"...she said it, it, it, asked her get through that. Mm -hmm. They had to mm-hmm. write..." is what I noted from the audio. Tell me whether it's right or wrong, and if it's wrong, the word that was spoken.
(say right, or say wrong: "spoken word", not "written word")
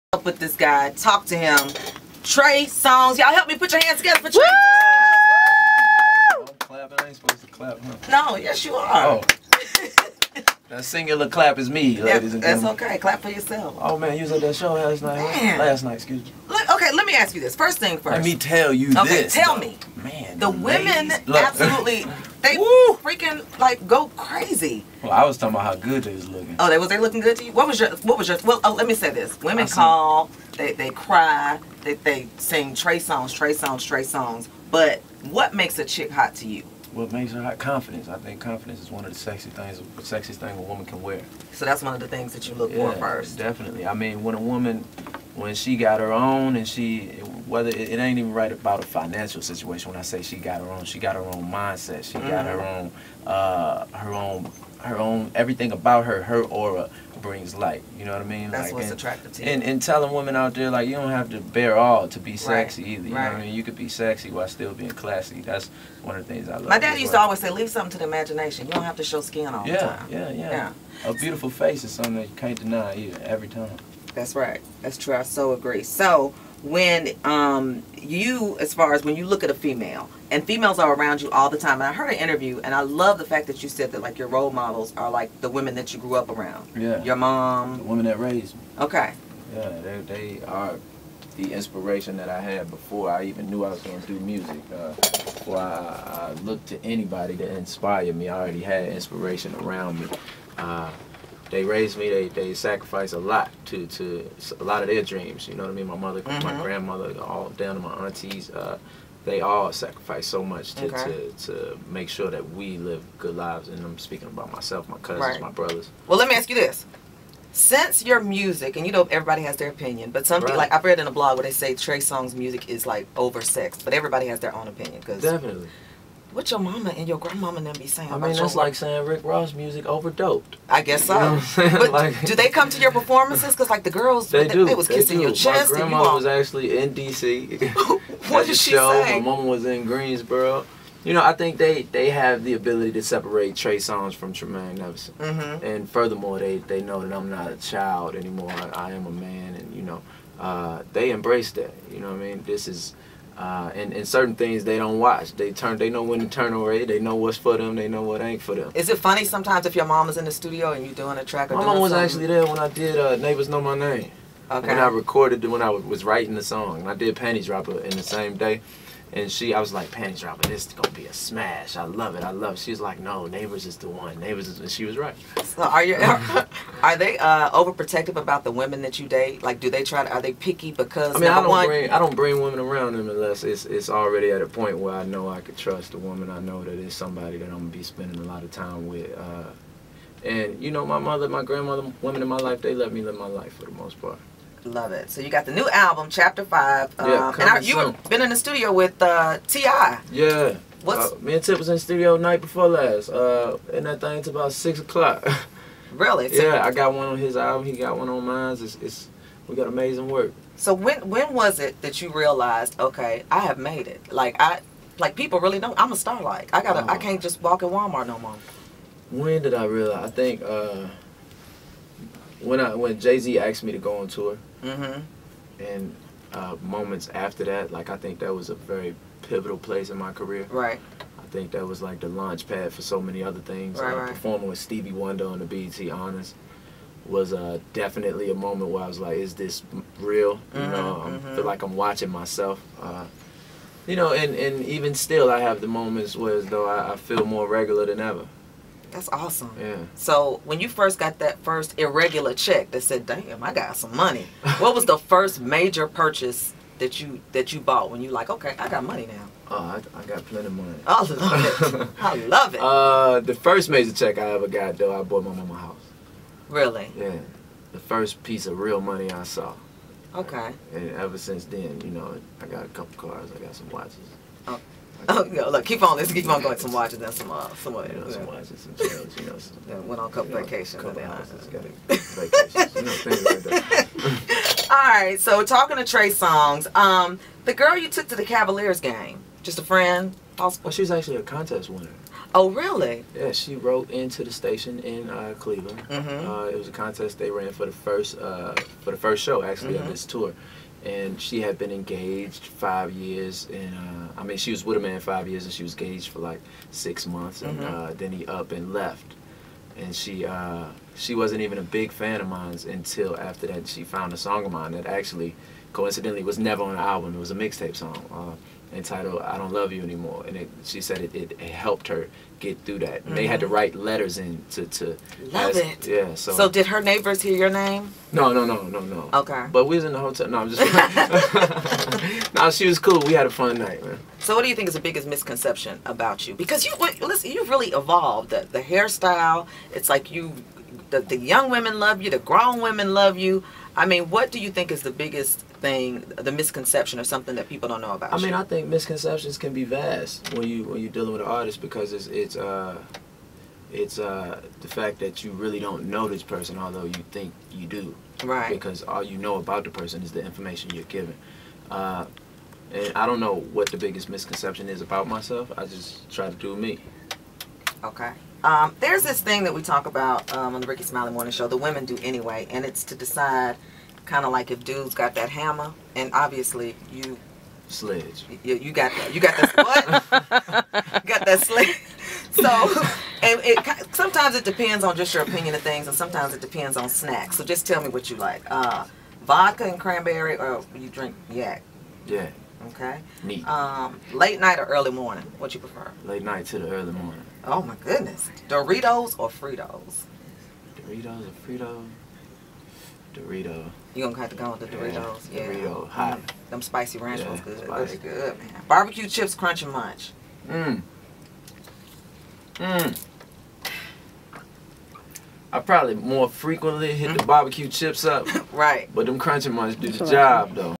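wrong: "helped", not "asked".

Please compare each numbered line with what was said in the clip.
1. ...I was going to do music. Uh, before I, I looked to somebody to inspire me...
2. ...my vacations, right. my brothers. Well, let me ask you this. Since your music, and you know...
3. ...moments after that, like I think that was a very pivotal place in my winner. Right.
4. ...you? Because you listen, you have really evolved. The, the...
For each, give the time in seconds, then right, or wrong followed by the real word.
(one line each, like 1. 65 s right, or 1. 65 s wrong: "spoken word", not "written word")
1. 93 s wrong: "anybody", not "somebody"
2. 114 s wrong: "cousins", not "vacations"
3. 226 s wrong: "career", not "winner"
4. 336 s right.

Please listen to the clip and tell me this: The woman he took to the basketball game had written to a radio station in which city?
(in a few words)
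Cleveland.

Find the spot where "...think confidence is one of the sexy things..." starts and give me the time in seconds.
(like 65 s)
38 s.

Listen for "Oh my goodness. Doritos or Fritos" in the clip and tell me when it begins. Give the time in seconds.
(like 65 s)
397 s.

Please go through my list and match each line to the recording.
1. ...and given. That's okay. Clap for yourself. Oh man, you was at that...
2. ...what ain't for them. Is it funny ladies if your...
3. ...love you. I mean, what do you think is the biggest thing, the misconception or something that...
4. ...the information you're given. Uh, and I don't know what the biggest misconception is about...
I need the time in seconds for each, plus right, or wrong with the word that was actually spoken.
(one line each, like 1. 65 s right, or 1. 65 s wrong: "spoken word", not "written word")
1. 12 s wrong: "gentlemen", not "given"
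2. 158 s wrong: "sometimes", not "ladies"
3. 342 s right
4. 360 s right.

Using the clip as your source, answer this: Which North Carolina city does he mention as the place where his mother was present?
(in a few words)
Greensboro.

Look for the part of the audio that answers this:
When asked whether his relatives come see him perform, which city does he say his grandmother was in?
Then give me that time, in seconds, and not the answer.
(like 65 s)
136 s.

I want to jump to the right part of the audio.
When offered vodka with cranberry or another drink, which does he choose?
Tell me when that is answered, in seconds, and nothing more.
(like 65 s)
391 s.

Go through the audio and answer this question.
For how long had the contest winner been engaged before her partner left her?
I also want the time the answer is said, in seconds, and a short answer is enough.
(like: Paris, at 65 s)
6 months, at 306 s.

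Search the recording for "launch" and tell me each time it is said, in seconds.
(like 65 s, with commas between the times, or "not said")
232 s.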